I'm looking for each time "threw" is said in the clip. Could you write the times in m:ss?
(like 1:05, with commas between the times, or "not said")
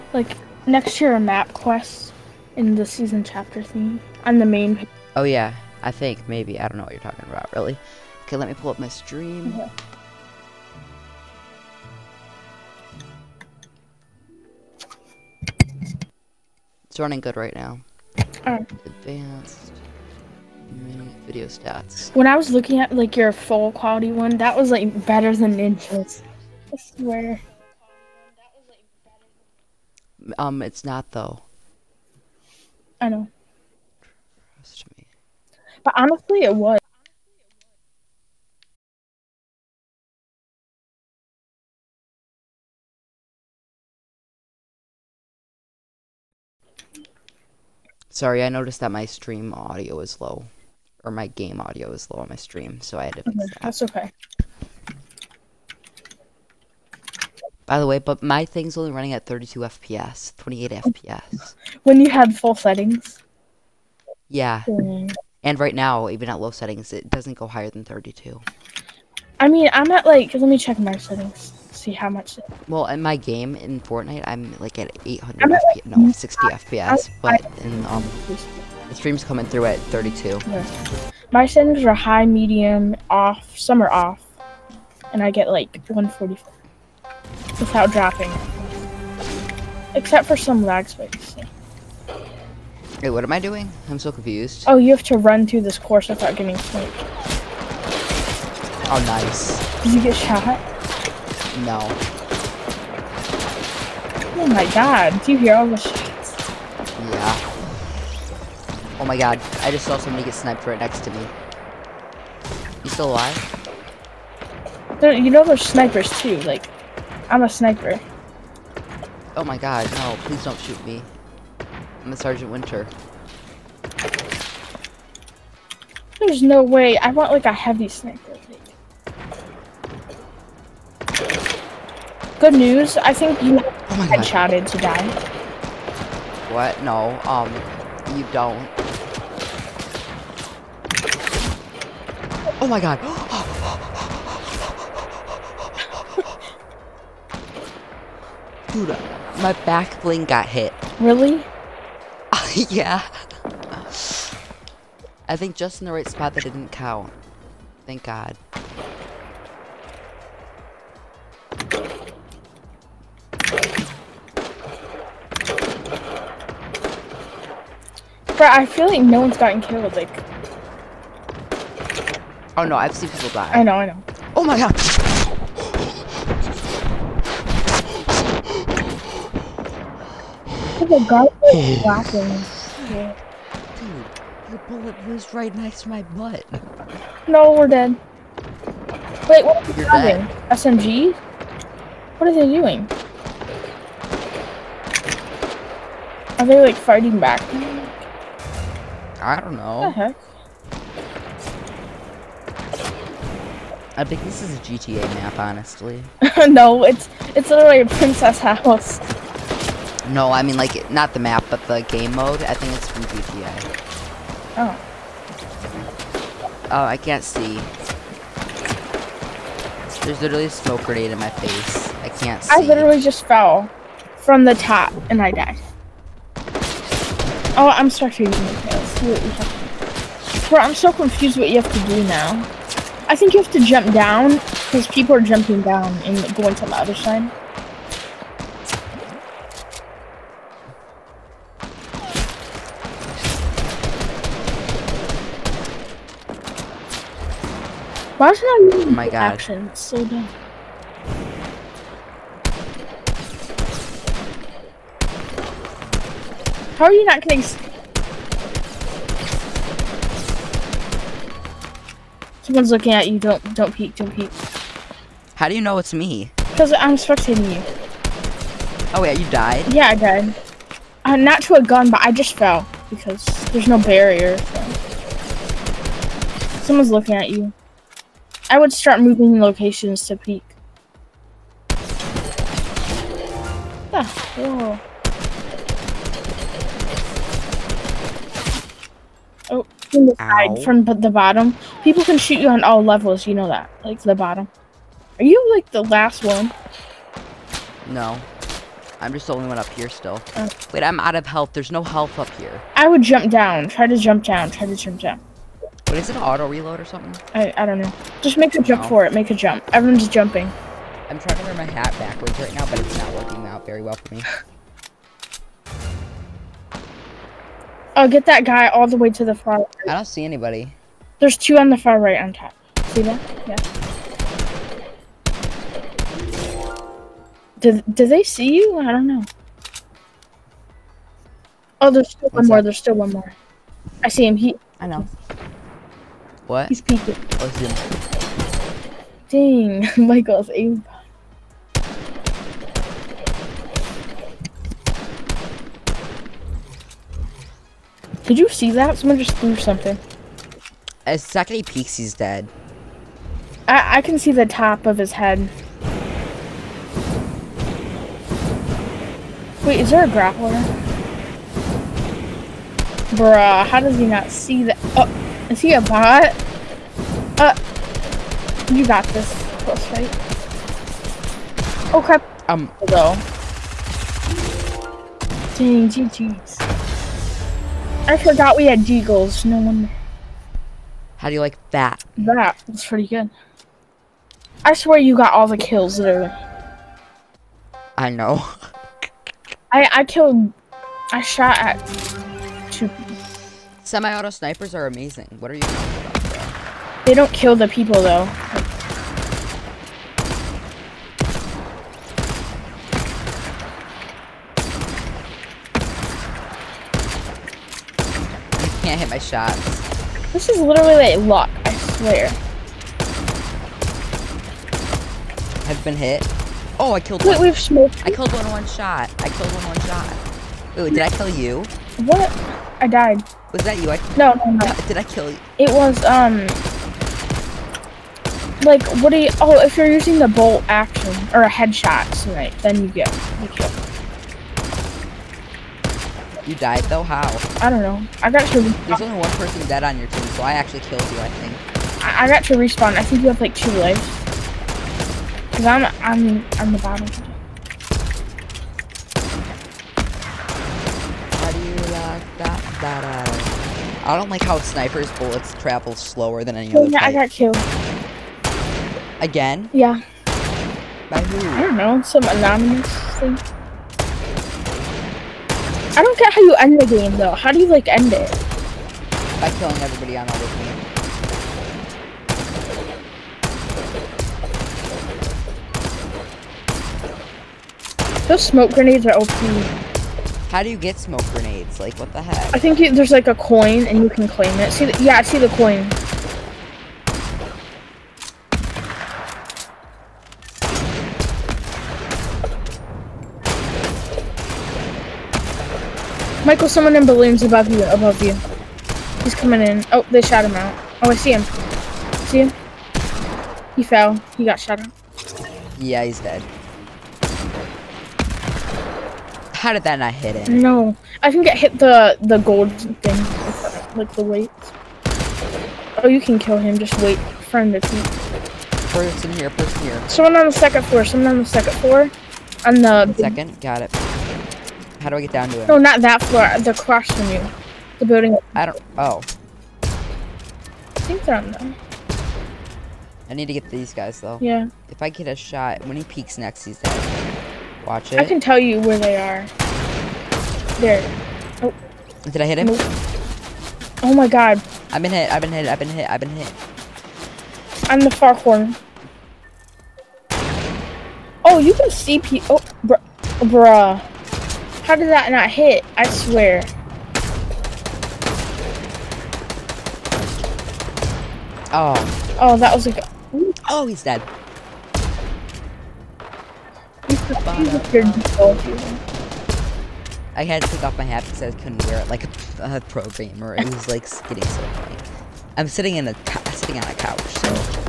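5:49.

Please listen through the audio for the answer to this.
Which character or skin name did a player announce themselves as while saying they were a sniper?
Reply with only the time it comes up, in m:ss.
2:02.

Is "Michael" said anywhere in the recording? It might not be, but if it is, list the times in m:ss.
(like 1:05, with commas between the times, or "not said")
5:40, 8:16.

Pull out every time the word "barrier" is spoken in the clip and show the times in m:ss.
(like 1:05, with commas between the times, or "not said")
4:33.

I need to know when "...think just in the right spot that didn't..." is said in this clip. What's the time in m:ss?
2:35.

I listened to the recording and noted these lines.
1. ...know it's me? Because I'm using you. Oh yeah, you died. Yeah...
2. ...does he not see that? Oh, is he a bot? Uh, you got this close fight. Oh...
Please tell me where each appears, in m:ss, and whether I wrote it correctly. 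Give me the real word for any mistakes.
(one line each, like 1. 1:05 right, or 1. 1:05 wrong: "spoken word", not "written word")
1. 4:25 wrong: "spectating", not "using"
2. 6:03 right.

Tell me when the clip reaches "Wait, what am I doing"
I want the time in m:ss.
1:33.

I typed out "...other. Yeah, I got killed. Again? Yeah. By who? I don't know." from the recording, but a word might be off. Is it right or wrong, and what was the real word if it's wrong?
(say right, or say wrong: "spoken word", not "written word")
right.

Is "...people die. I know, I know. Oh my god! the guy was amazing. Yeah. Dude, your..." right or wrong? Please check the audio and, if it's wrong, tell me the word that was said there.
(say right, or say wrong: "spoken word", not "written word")
wrong: "laughing", not "amazing".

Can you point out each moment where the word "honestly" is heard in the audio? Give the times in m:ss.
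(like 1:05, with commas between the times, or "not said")
0:35, 3:25.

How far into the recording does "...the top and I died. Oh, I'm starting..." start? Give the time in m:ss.
3:44.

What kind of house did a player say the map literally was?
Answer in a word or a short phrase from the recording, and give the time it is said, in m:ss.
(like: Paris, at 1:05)
a princess house, at 3:27.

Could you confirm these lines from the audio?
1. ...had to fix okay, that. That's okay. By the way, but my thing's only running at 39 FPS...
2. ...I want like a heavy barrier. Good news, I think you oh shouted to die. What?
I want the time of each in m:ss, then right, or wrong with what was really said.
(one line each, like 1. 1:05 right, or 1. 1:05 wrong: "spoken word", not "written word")
1. 0:53 wrong: "32", not "39"
2. 2:06 wrong: "sniper", not "barrier".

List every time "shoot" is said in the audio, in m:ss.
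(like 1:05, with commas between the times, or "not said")
2:00, 4:52.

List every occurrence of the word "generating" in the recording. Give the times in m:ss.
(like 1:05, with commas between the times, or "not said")
not said.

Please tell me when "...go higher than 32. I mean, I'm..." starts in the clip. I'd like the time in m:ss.
1:07.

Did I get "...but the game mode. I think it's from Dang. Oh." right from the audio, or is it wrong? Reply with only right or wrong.
wrong.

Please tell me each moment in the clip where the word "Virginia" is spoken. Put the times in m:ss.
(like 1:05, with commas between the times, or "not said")
not said.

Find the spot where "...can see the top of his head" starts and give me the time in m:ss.
5:54.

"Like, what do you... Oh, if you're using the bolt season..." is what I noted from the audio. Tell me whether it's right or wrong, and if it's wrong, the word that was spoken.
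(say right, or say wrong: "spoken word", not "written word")
wrong: "action", not "season".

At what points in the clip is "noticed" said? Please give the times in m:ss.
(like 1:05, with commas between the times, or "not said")
0:48.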